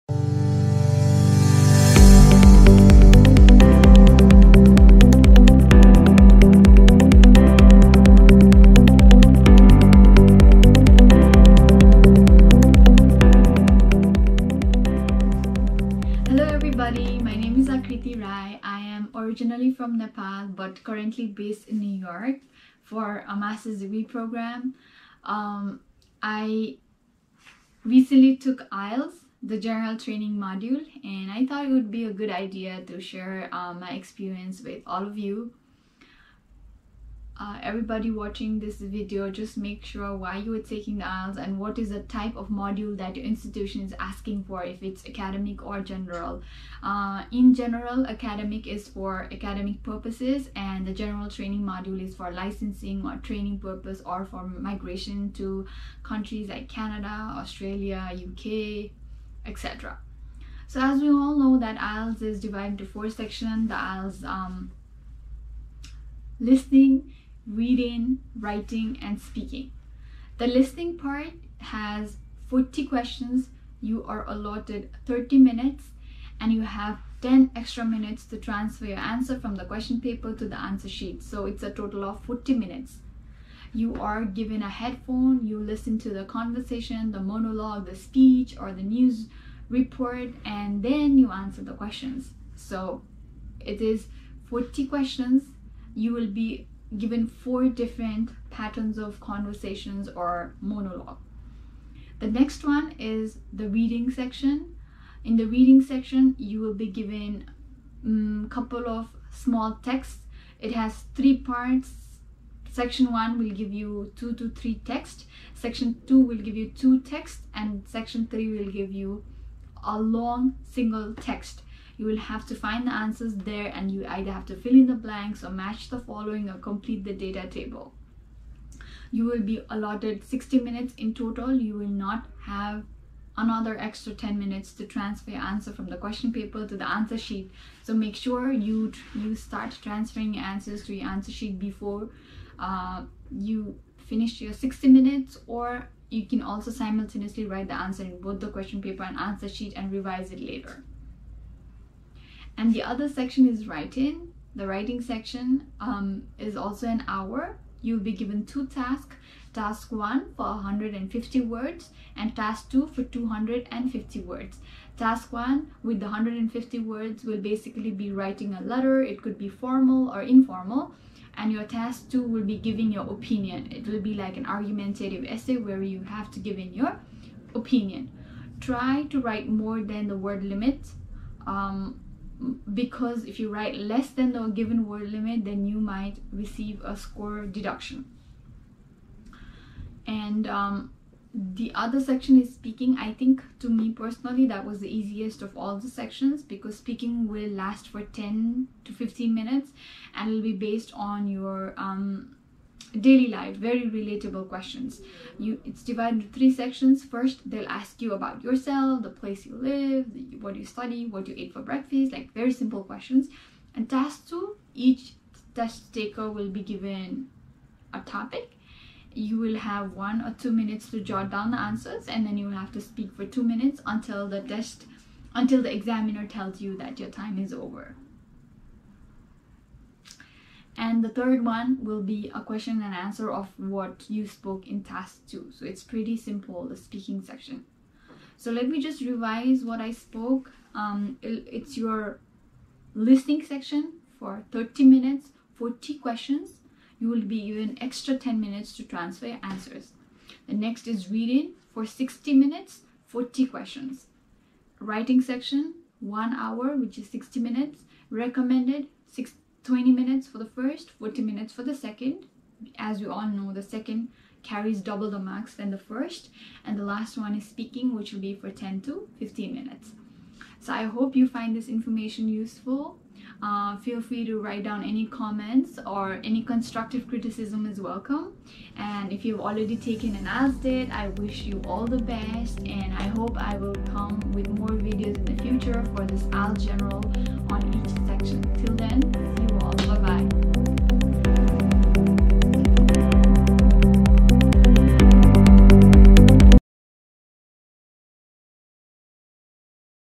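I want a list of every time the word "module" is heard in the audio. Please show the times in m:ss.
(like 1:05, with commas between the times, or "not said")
0:30, 0:42, 0:51.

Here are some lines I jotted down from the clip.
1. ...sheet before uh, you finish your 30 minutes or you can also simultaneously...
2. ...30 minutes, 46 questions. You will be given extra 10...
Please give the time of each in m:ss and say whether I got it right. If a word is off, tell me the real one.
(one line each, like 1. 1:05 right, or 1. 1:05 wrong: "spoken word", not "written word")
1. 2:21 wrong: "60", not "30"
2. 4:04 wrong: "40", not "46".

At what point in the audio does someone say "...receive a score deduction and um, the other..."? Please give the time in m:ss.
3:06.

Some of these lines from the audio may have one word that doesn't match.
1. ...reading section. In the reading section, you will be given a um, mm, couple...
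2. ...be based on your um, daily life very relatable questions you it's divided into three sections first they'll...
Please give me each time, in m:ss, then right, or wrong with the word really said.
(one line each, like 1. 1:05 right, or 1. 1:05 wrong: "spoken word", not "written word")
1. 1:43 right
2. 3:20 right.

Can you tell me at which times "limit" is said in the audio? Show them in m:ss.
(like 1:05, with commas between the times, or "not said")
3:00, 3:05.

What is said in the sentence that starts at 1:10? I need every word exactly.
The listening part has 40 questions.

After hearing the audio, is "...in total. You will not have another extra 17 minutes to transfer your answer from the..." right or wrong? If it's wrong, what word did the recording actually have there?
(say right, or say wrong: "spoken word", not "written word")
wrong: "10", not "17".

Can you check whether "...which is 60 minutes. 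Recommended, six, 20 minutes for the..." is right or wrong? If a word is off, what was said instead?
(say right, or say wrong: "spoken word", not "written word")
right.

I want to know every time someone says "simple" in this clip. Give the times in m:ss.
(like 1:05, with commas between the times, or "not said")
3:32, 3:56.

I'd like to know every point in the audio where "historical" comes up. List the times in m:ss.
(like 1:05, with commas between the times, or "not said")
not said.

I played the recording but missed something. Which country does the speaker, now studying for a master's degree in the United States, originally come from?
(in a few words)
Nepal.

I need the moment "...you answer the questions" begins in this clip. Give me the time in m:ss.
1:31.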